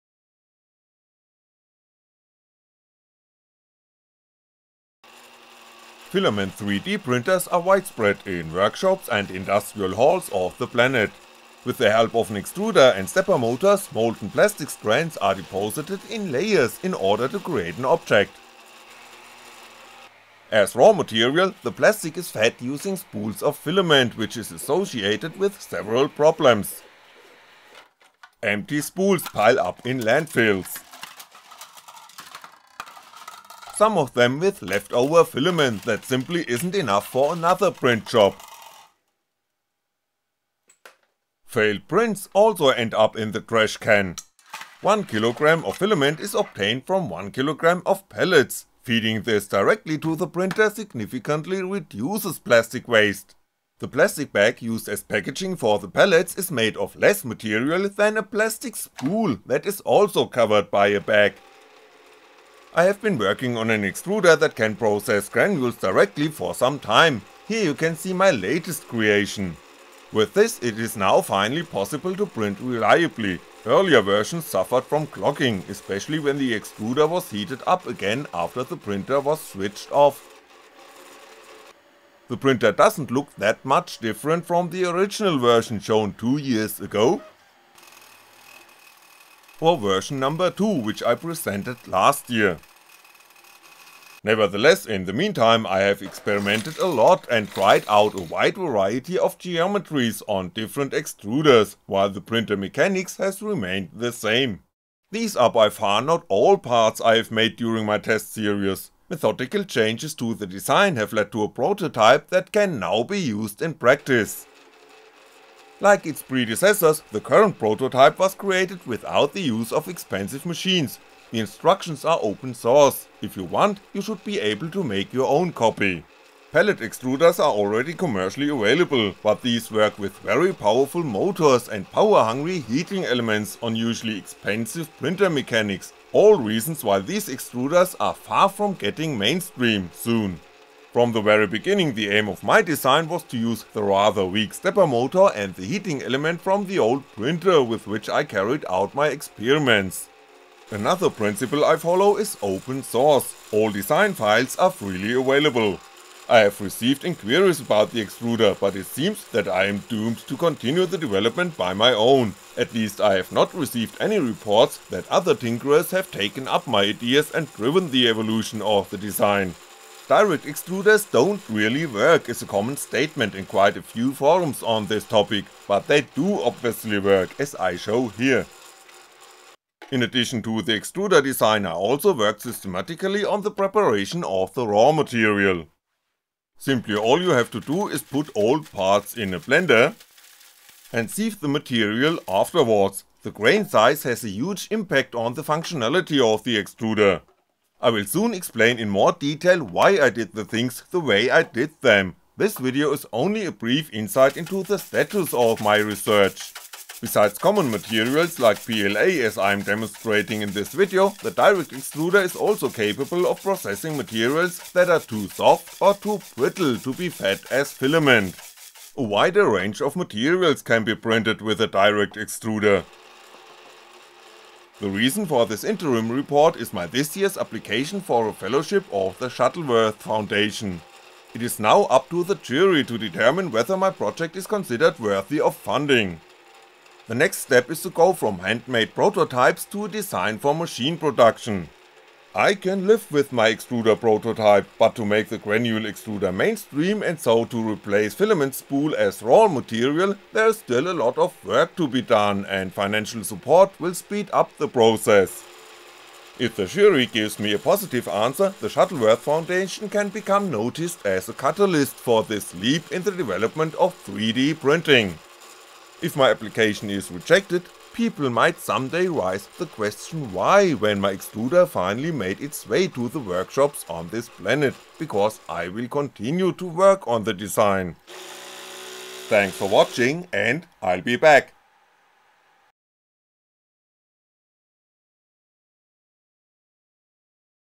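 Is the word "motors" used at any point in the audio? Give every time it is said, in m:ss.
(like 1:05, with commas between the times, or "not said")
0:13, 2:11, 2:24.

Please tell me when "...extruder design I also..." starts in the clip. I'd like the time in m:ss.
3:00.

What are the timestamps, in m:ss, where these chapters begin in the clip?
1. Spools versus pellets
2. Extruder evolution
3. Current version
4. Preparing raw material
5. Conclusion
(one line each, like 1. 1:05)
1. 0:19
2. 1:21
3. 1:54
4. 2:58
5. 3:25.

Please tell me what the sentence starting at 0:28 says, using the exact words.
Empty spools pile up in landfills some of them with leftover filament that simply isn't enough for another print job.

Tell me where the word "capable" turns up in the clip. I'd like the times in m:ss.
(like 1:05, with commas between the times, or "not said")
3:32.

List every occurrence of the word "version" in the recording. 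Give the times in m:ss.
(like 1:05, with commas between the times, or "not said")
1:14, 1:25, 1:29.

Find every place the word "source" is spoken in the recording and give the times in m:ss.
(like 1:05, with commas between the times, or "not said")
2:02, 2:32.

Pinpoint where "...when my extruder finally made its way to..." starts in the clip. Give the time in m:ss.
4:30.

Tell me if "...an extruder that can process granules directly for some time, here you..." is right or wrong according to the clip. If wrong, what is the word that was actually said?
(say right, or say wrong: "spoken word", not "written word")
right.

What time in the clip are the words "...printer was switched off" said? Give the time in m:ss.
1:18.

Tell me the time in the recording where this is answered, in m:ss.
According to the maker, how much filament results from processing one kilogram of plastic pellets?
0:44.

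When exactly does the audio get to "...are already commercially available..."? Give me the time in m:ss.
2:07.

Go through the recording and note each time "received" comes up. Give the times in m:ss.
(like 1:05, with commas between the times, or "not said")
2:36, 2:43.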